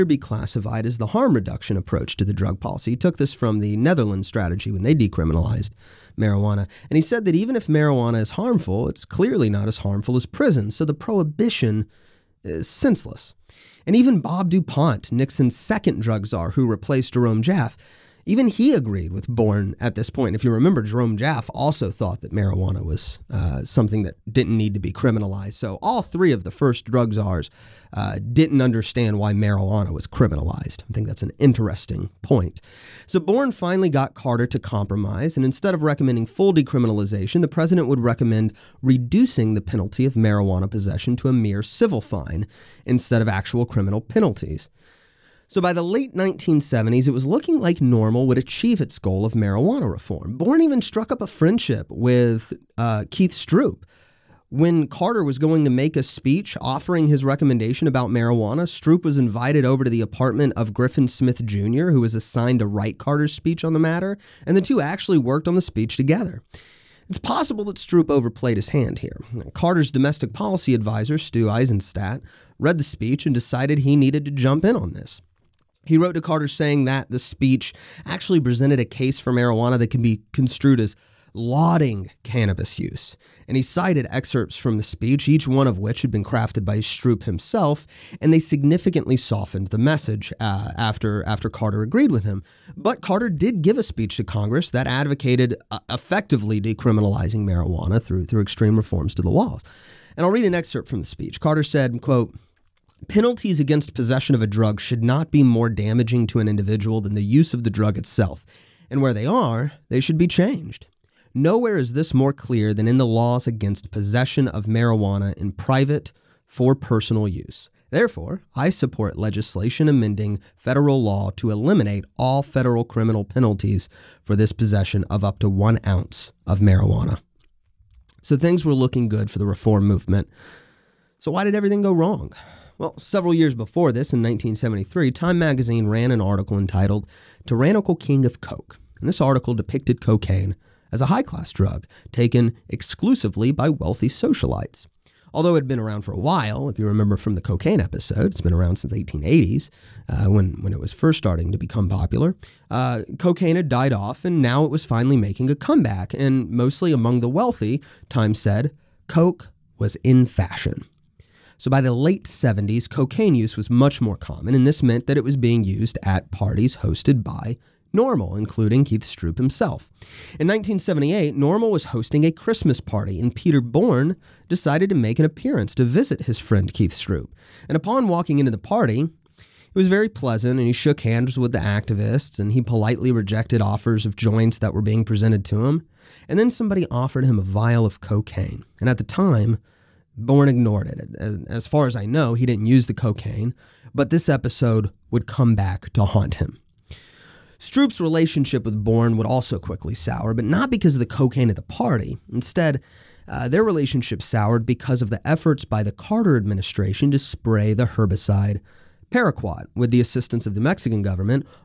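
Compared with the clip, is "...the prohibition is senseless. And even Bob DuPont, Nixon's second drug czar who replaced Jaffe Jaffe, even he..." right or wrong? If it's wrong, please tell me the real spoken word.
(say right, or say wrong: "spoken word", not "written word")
wrong: "Jerome", not "Jaffe".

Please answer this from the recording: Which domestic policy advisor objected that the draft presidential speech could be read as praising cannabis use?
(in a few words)
Stu Eizenstat.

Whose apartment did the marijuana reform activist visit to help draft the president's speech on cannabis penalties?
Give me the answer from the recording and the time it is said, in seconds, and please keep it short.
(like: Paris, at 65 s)
Griffin Smith Jr., at 60 s.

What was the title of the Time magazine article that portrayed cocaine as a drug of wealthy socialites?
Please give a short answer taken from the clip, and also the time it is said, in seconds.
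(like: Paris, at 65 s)
Tyrannical King of Coke, at 137 s.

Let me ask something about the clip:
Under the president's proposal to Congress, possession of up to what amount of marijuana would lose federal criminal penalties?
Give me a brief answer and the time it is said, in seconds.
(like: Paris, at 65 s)
1 ounce, at 125 s.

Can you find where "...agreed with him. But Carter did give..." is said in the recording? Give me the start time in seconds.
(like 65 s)
91 s.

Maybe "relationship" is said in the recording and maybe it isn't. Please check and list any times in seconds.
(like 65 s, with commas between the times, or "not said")
198 s, 203 s.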